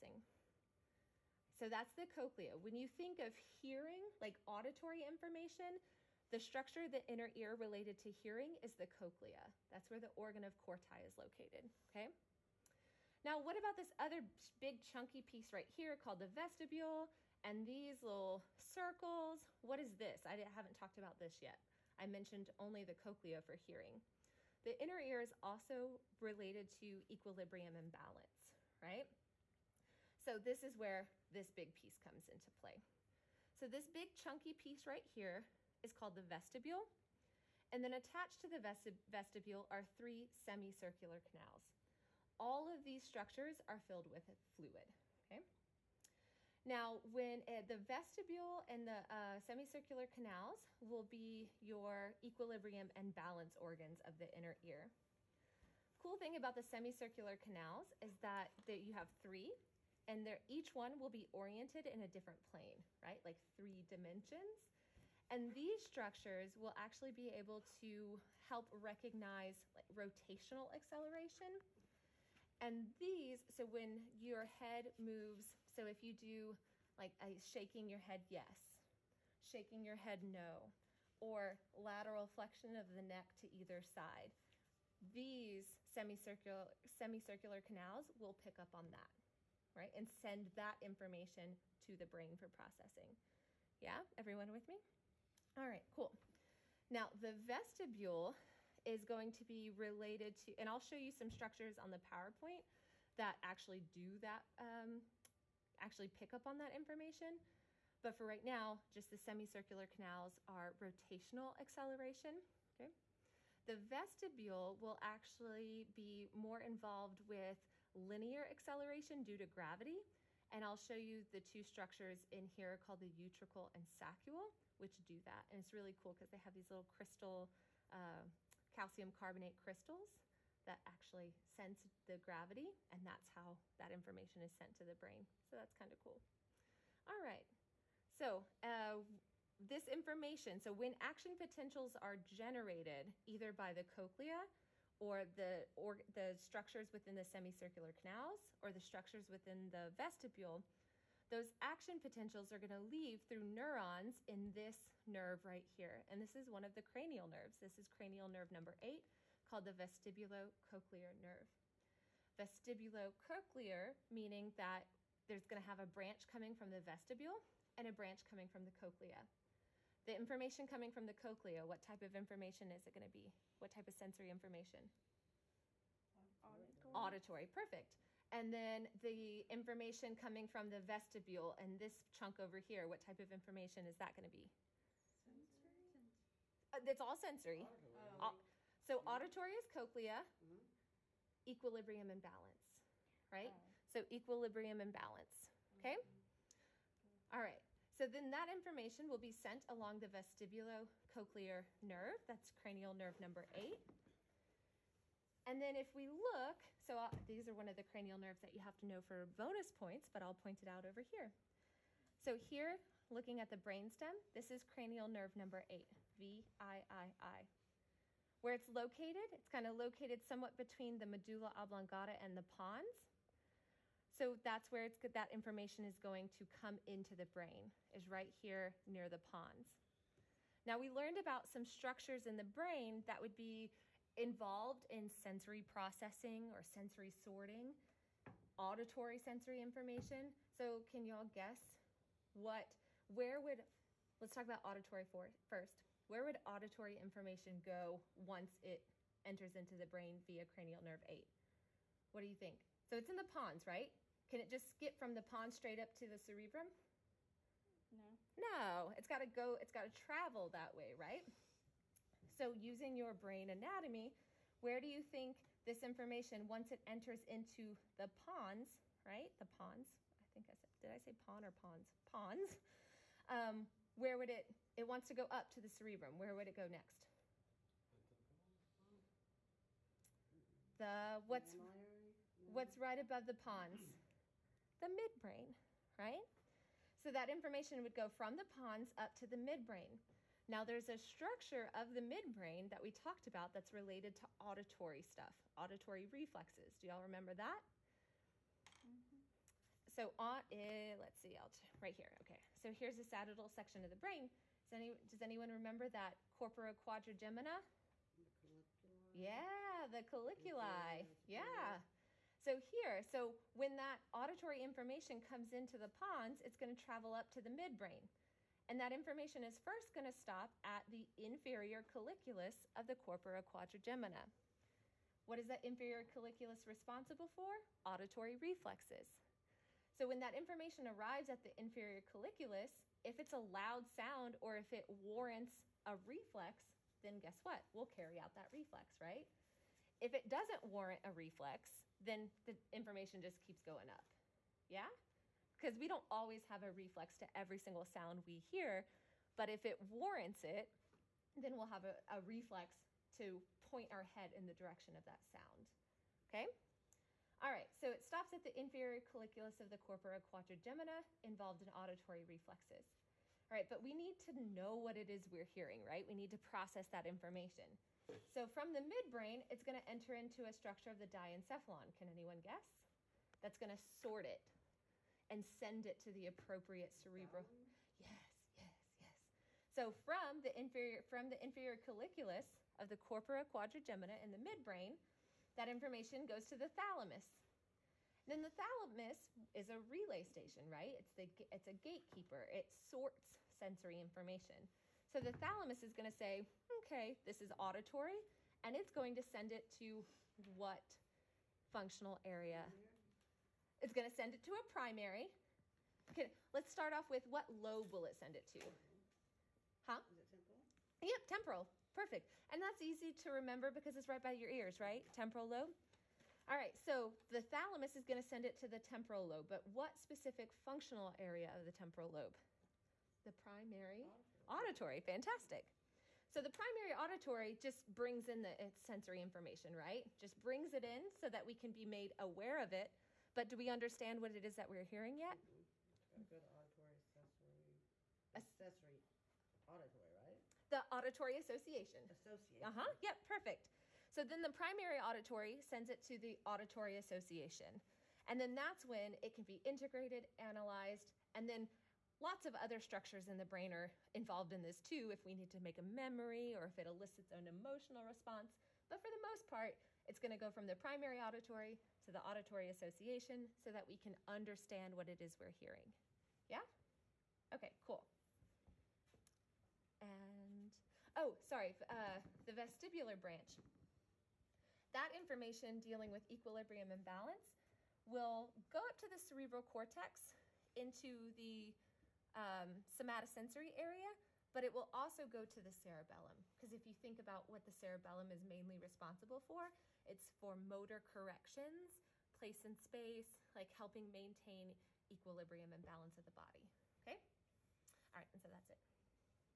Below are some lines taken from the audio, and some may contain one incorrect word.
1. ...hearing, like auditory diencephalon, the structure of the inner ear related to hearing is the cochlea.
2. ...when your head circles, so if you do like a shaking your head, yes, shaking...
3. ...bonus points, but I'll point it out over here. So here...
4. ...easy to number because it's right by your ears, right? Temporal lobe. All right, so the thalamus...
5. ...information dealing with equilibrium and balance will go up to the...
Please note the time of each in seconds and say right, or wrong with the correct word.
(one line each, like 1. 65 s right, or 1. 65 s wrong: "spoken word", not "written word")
1. 3 s wrong: "information", not "diencephalon"
2. 73 s wrong: "moves", not "circles"
3. 209 s right
4. 412 s wrong: "remember", not "number"
5. 475 s right.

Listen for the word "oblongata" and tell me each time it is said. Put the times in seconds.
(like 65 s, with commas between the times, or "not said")
221 s.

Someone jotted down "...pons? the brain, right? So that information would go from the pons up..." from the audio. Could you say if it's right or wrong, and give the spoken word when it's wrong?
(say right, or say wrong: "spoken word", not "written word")
wrong: "midbrain", not "brain".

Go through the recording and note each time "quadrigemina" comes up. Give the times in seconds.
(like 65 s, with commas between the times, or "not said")
306 s, 323 s, 360 s, 383 s.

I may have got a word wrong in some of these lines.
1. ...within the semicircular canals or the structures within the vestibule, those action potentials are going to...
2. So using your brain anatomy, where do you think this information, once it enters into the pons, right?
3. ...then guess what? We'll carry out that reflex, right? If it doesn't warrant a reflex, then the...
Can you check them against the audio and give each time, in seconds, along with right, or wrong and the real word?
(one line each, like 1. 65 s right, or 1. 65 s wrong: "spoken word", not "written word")
1. 146 s right
2. 262 s right
3. 337 s right.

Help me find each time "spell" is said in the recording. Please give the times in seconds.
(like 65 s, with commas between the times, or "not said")
not said.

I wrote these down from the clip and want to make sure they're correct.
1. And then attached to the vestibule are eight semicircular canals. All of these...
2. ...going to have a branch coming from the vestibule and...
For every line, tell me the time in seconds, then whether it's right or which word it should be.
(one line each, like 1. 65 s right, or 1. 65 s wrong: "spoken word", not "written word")
1. 37 s wrong: "three", not "eight"
2. 165 s right.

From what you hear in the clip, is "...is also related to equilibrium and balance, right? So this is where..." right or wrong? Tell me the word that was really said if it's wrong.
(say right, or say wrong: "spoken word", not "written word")
right.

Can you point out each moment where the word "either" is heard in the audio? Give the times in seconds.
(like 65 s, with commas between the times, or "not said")
83 s, 143 s.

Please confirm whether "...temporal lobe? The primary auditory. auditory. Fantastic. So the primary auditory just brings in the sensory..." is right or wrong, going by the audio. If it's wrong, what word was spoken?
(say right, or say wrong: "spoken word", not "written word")
right.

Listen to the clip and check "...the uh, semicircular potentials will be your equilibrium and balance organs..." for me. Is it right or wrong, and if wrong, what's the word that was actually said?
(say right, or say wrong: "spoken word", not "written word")
wrong: "canals", not "potentials".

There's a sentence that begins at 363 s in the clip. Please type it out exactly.
All right, but we need to know what it is we're hearing, right?